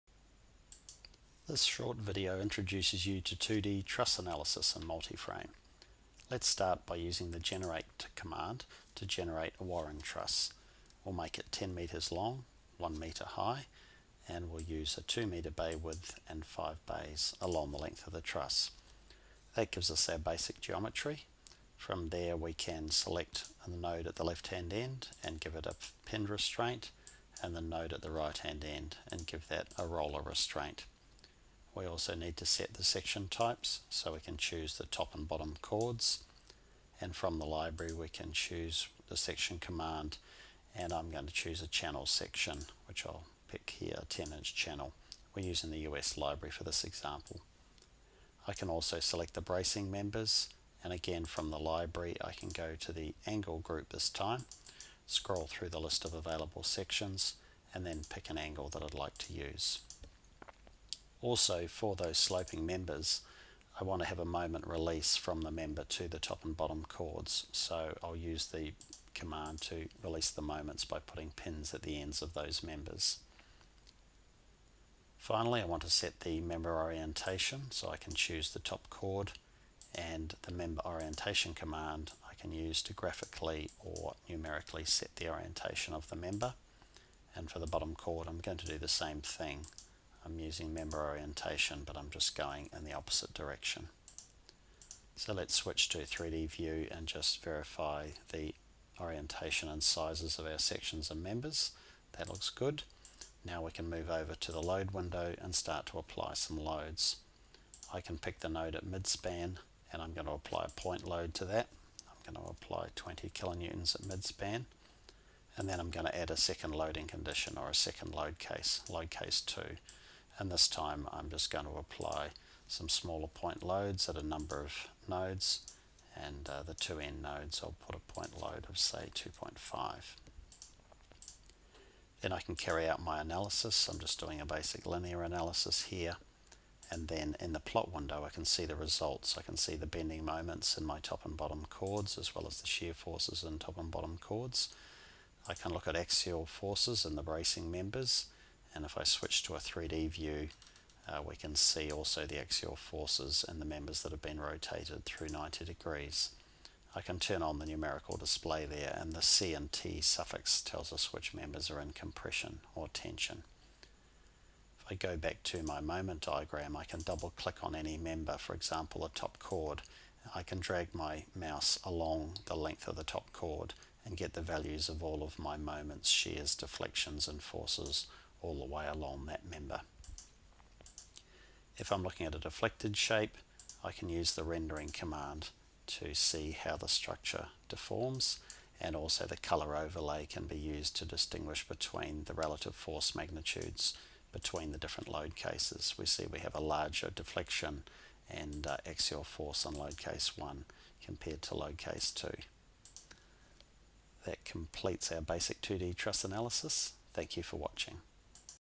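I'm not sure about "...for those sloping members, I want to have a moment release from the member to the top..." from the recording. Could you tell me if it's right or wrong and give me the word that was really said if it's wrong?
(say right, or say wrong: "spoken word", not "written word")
right.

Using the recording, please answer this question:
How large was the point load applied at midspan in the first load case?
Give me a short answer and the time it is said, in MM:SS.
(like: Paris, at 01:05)
20 kilonewtons, at 01:52.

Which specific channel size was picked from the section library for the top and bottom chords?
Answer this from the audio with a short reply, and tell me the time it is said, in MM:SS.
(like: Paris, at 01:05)
10 inch channel, at 00:44.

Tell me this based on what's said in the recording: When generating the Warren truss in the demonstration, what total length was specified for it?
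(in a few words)
10 meters.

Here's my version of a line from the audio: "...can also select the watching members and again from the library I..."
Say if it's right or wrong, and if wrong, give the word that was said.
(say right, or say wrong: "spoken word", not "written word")
wrong: "bracing", not "watching".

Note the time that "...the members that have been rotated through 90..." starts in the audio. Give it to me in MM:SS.
02:33.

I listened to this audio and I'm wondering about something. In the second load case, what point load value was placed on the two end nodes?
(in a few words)
2.5.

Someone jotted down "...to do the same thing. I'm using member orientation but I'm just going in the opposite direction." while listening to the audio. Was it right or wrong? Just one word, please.
right.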